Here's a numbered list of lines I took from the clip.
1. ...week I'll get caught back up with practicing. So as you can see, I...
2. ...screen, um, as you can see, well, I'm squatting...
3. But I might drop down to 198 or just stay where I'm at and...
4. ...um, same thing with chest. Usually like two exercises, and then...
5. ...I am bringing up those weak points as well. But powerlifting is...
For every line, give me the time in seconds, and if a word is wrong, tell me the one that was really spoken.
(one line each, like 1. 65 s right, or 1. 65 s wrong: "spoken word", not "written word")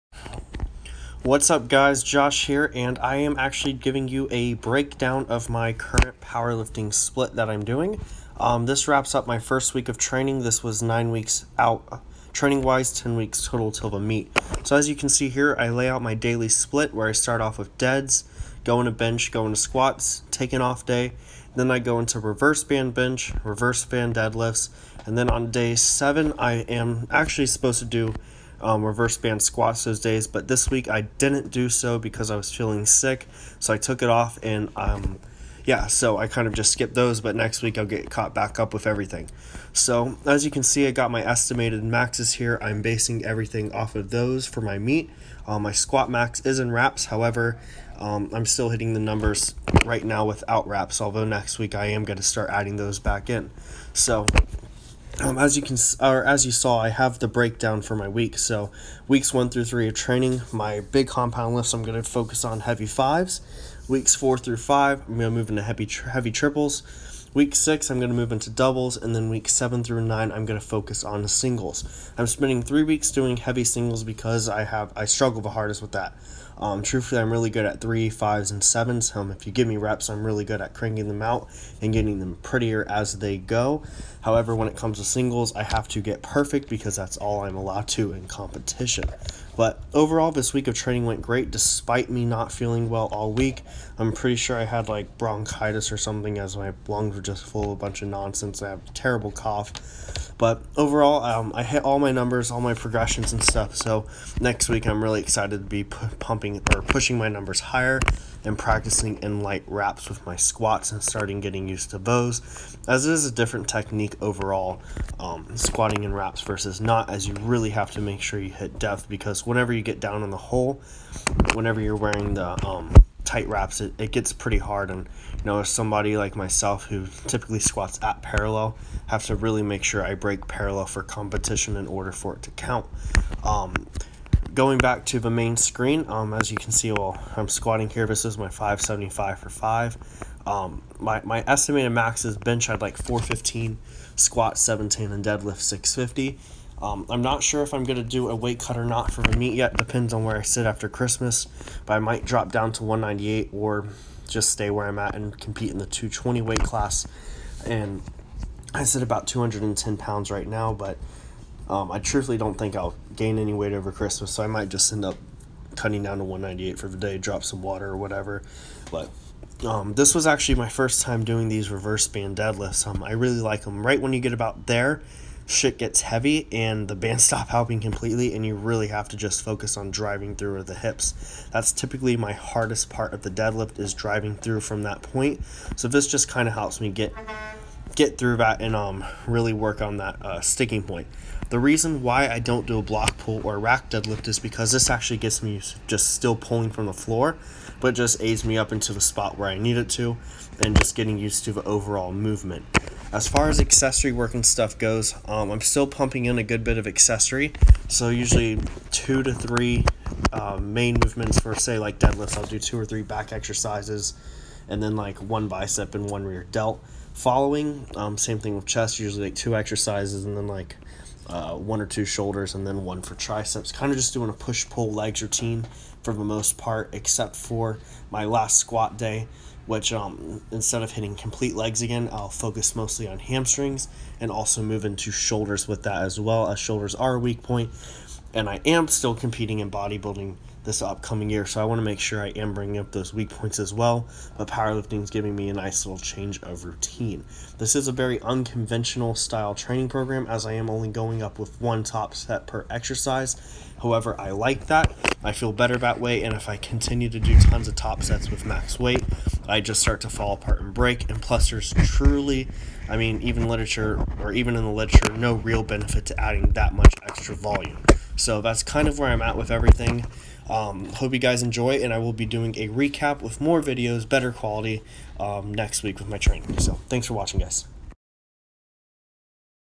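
1. 37 s wrong: "everything", not "practicing"
2. 135 s right
3. 151 s right
4. 217 s right
5. 242 s right.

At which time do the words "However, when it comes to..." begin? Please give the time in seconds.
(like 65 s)
84 s.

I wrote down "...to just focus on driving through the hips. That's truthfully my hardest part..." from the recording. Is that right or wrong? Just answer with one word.
wrong.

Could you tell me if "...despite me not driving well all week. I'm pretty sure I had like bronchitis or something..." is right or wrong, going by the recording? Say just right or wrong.
wrong.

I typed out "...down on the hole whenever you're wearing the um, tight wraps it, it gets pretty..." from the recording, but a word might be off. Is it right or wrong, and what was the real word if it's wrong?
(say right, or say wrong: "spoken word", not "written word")
right.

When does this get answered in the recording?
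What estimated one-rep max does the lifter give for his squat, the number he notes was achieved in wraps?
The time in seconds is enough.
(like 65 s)
144 s.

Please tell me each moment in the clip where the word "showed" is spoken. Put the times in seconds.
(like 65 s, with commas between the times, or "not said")
not said.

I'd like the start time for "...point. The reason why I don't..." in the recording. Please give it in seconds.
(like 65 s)
190 s.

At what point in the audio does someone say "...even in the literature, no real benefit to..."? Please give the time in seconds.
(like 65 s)
264 s.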